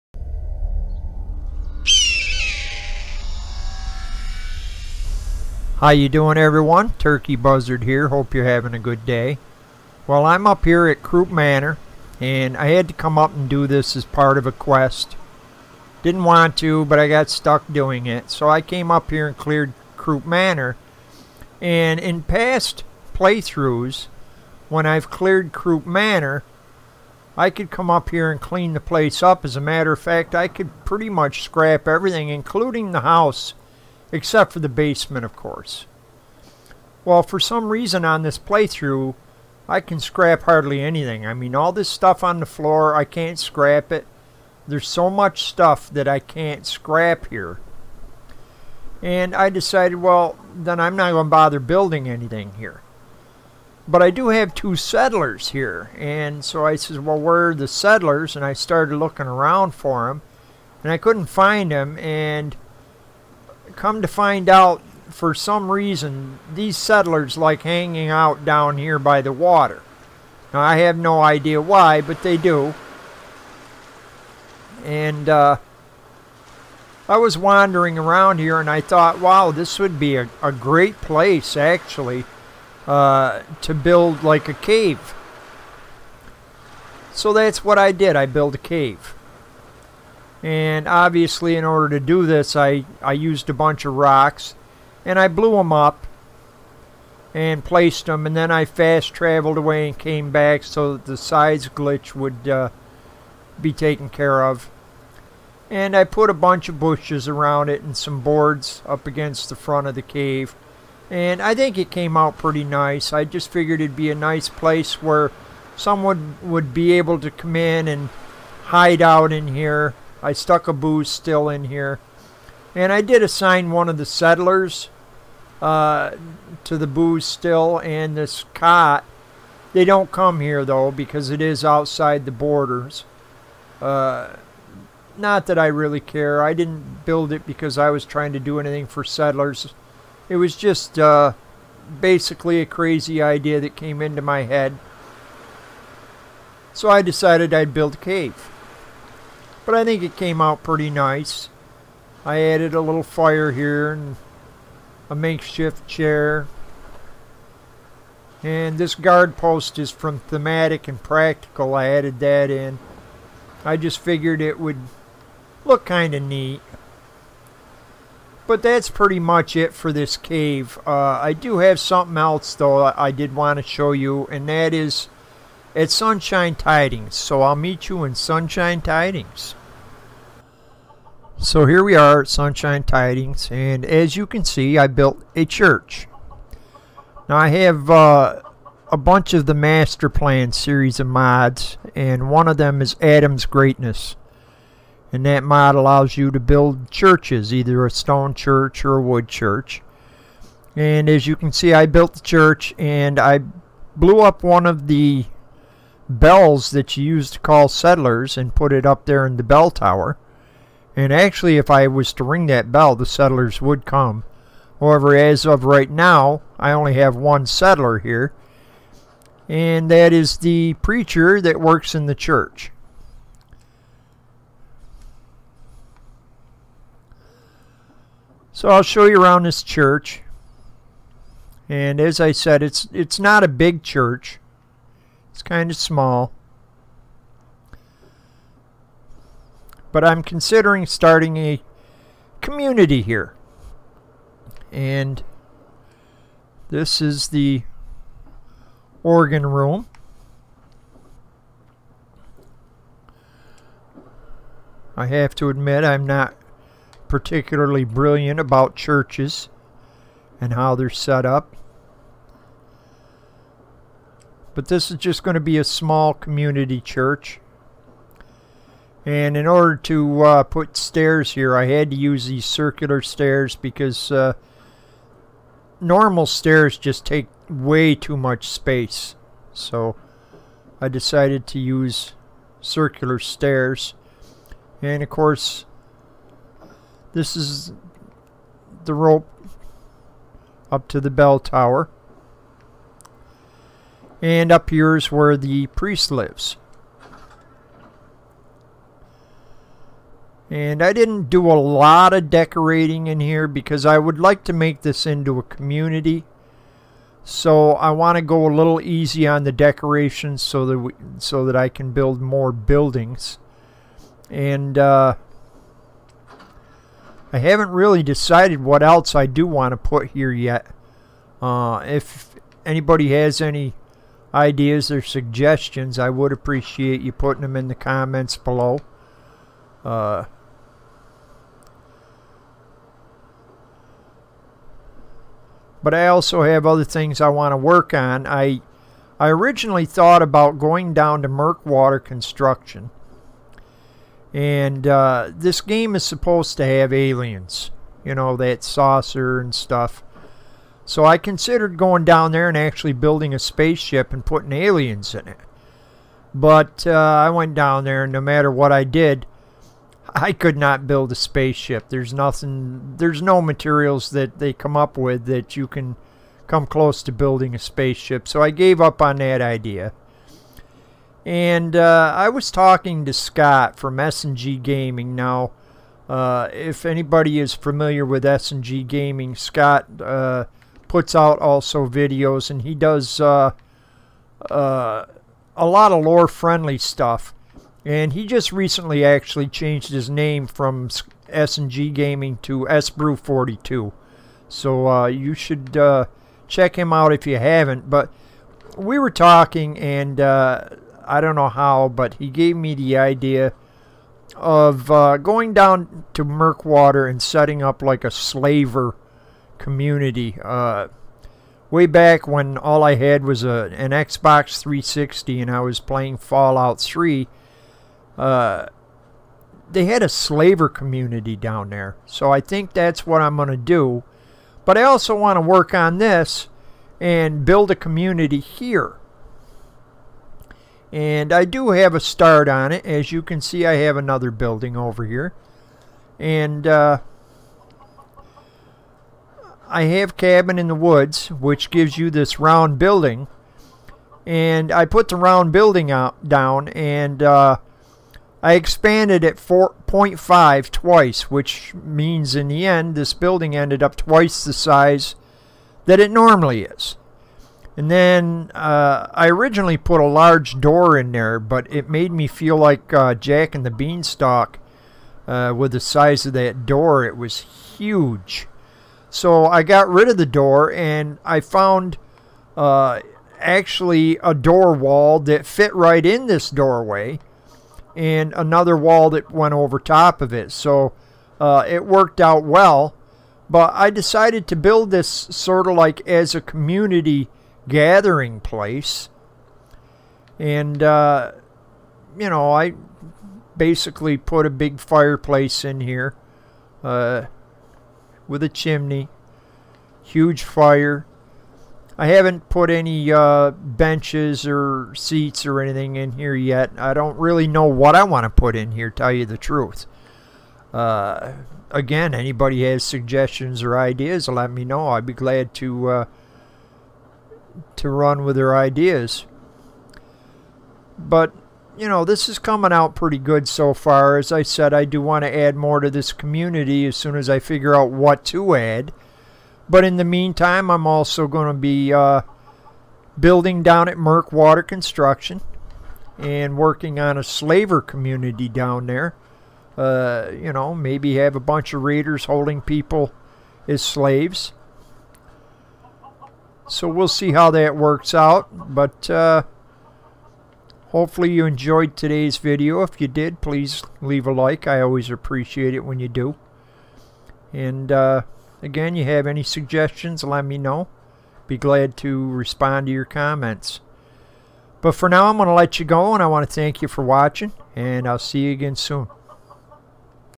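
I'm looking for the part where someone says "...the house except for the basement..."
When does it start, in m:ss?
0:32.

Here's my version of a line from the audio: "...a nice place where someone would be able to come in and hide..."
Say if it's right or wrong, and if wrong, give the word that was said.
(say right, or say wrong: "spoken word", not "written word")
right.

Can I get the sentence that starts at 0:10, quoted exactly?
Well, I'm up here at Croup Manor and I had to come up and do this as part of a quest.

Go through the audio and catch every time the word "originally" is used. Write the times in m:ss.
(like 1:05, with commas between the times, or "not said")
5:39, 7:39.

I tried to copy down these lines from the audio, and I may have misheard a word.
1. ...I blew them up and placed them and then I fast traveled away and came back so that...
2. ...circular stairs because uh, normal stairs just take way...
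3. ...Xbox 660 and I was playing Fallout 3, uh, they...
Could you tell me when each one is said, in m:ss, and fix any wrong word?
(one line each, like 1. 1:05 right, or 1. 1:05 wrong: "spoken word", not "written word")
1. 1:35 right
2. 4:32 right
3. 6:53 wrong: "360", not "660".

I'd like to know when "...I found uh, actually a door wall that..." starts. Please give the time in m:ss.
7:51.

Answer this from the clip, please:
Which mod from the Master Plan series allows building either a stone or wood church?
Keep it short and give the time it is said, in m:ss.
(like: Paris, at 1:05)
Adam's Greatness, at 3:13.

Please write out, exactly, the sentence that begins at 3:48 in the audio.
So I'll show you around this church.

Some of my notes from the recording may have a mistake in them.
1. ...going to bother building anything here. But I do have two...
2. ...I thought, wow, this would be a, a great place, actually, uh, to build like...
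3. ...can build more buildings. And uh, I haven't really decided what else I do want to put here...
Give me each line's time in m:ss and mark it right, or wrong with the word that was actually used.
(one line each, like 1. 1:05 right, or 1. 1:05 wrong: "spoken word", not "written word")
1. 0:51 right
2. 1:18 right
3. 5:11 right.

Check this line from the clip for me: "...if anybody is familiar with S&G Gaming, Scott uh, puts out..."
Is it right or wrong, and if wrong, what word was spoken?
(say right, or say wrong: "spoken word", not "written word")
right.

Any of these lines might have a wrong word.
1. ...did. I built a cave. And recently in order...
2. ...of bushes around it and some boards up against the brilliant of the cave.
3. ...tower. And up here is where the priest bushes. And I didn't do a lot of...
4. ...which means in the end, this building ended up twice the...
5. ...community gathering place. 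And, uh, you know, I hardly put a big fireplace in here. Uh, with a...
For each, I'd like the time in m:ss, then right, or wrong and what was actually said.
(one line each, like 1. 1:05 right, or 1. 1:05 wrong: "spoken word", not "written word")
1. 1:27 wrong: "obviously", not "recently"
2. 1:46 wrong: "front", not "brilliant"
3. 4:51 wrong: "lives", not "bushes"
4. 7:31 right
5. 8:06 wrong: "basically", not "hardly".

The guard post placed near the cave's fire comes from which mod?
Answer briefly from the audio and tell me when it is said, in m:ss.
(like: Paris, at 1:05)
Thematic and Practical, at 2:40.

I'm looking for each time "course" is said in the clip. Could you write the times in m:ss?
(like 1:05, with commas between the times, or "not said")
0:35, 4:45.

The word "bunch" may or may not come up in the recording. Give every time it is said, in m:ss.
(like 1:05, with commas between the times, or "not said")
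1:33, 1:46, 3:08, 9:01.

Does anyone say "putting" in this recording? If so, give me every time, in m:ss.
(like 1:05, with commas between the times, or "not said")
5:27, 5:54.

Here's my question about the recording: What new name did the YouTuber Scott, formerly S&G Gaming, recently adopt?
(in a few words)
S Brew 42.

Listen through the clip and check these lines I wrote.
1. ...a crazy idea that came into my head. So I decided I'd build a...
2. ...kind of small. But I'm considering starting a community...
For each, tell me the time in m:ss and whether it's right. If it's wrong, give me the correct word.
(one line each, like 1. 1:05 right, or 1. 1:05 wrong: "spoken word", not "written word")
1. 2:22 right
2. 3:55 right.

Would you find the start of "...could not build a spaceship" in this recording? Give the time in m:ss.
6:00.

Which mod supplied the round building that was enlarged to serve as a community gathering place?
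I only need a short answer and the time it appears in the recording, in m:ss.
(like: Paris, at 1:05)
Cabin in the Woods, at 7:20.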